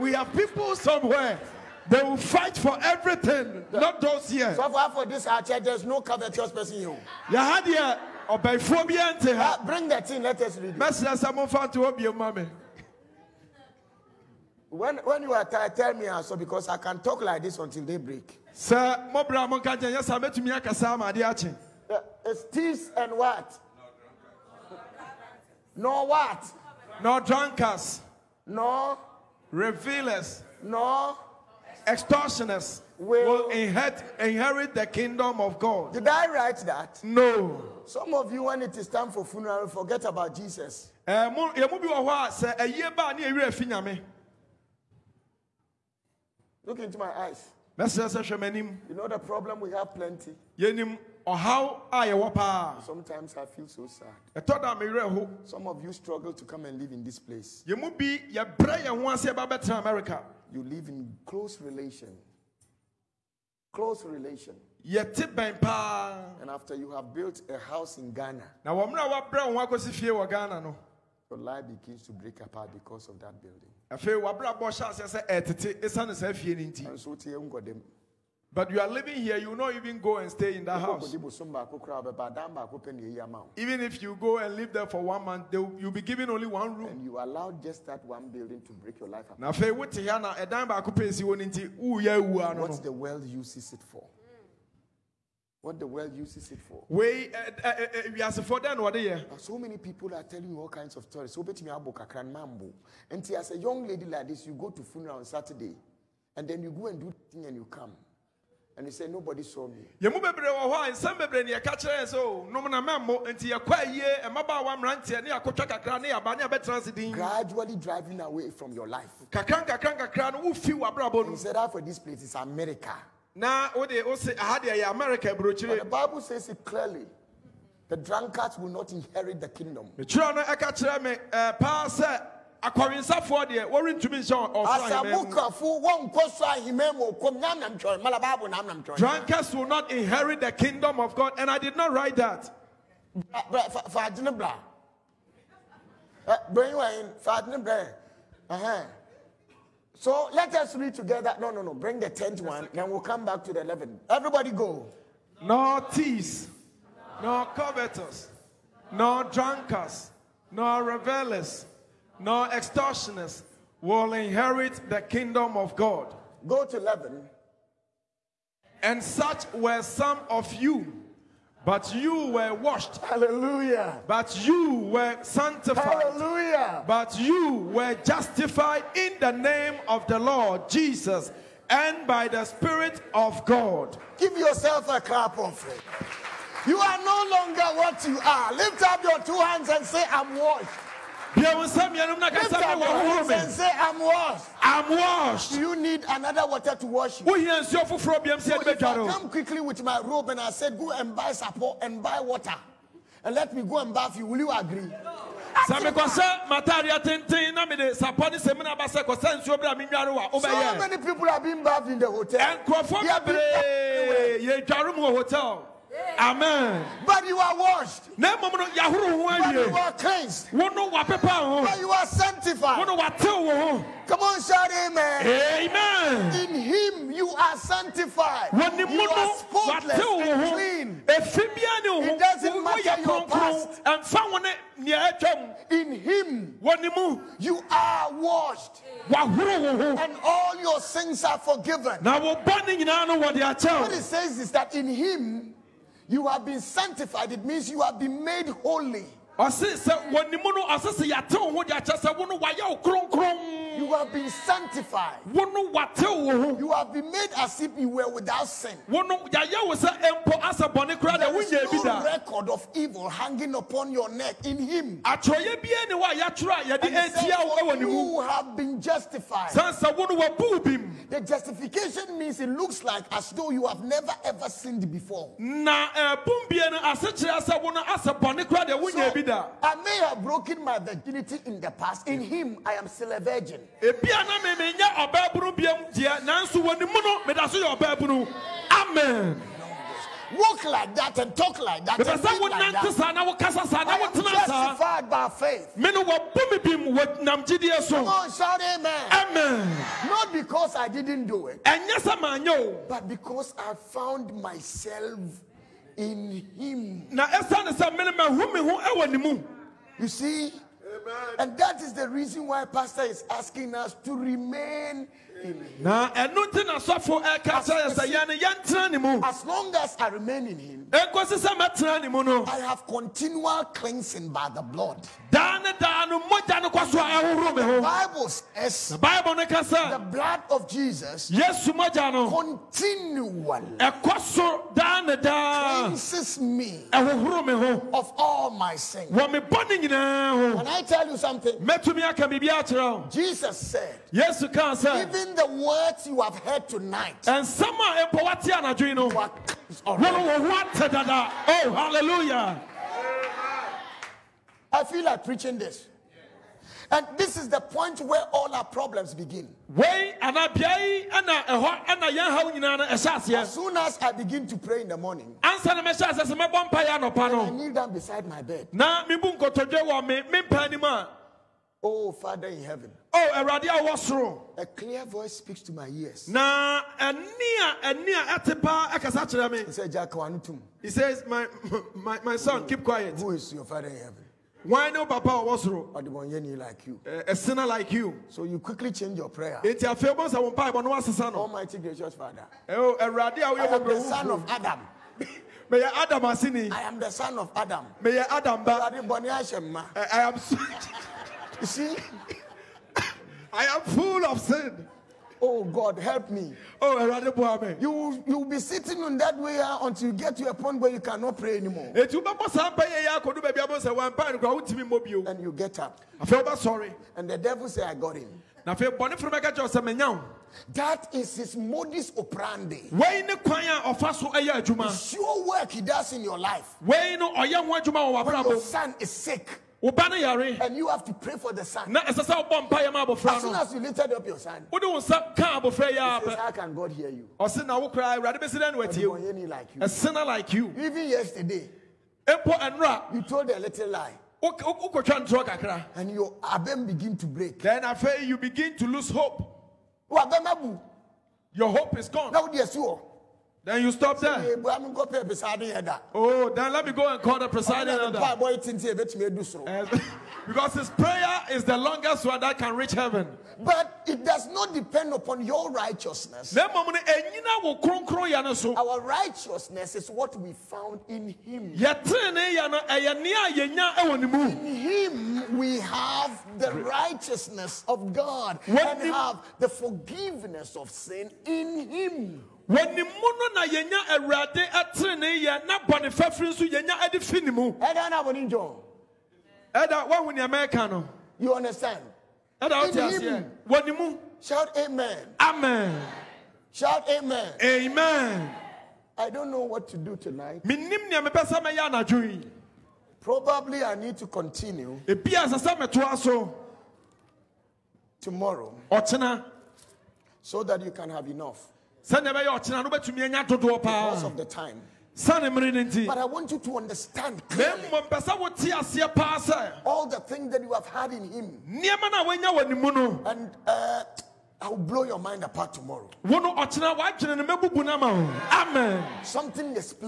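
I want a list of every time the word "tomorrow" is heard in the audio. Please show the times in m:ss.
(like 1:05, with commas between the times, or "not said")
8:28, 8:45.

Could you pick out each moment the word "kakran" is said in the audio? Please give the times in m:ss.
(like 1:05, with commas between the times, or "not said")
1:41, 1:59.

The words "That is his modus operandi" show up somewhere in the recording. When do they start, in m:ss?
7:00.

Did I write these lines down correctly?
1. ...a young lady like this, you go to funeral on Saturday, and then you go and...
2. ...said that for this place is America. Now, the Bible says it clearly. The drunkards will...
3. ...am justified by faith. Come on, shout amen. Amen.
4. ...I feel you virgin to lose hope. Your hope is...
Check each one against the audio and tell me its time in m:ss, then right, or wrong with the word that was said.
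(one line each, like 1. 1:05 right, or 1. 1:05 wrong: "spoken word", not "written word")
1. 1:43 right
2. 2:01 right
3. 4:53 right
4. 7:27 wrong: "begin", not "virgin".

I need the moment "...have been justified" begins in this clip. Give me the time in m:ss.
4:28.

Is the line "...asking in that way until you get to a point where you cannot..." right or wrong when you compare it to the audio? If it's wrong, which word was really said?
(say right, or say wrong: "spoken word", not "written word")
wrong: "sitting", not "asking".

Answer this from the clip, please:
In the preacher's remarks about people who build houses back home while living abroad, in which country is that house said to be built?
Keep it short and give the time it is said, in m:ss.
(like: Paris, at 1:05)
Ghana, at 1:08.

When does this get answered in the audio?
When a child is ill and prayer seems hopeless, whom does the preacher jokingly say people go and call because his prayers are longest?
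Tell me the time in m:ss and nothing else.
7:37.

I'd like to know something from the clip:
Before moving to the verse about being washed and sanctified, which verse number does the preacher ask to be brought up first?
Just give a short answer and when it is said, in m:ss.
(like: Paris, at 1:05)
10th, at 2:32.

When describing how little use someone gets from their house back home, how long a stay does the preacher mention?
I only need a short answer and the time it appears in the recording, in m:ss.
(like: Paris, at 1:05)
one month, at 1:25.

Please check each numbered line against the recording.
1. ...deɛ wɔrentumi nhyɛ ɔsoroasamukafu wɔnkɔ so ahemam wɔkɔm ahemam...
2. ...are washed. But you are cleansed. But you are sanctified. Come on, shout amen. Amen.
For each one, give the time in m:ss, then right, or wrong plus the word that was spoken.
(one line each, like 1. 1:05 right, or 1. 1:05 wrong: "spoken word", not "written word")
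1. 2:13 wrong: "nyamnam", not "ahemam"
2. 3:37 right.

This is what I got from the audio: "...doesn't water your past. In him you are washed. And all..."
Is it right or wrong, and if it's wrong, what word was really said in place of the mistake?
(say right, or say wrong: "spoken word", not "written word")
wrong: "matter", not "water".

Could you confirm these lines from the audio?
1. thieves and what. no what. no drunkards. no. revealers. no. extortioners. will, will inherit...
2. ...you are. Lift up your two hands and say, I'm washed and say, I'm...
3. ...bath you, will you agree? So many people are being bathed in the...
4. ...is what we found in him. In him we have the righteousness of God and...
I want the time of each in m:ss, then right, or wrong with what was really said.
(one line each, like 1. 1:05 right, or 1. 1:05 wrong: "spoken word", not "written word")
1. 0:22 right
2. 3:08 right
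3. 3:23 right
4. 7:49 right.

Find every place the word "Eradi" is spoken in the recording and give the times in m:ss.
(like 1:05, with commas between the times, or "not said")
6:13, 6:32.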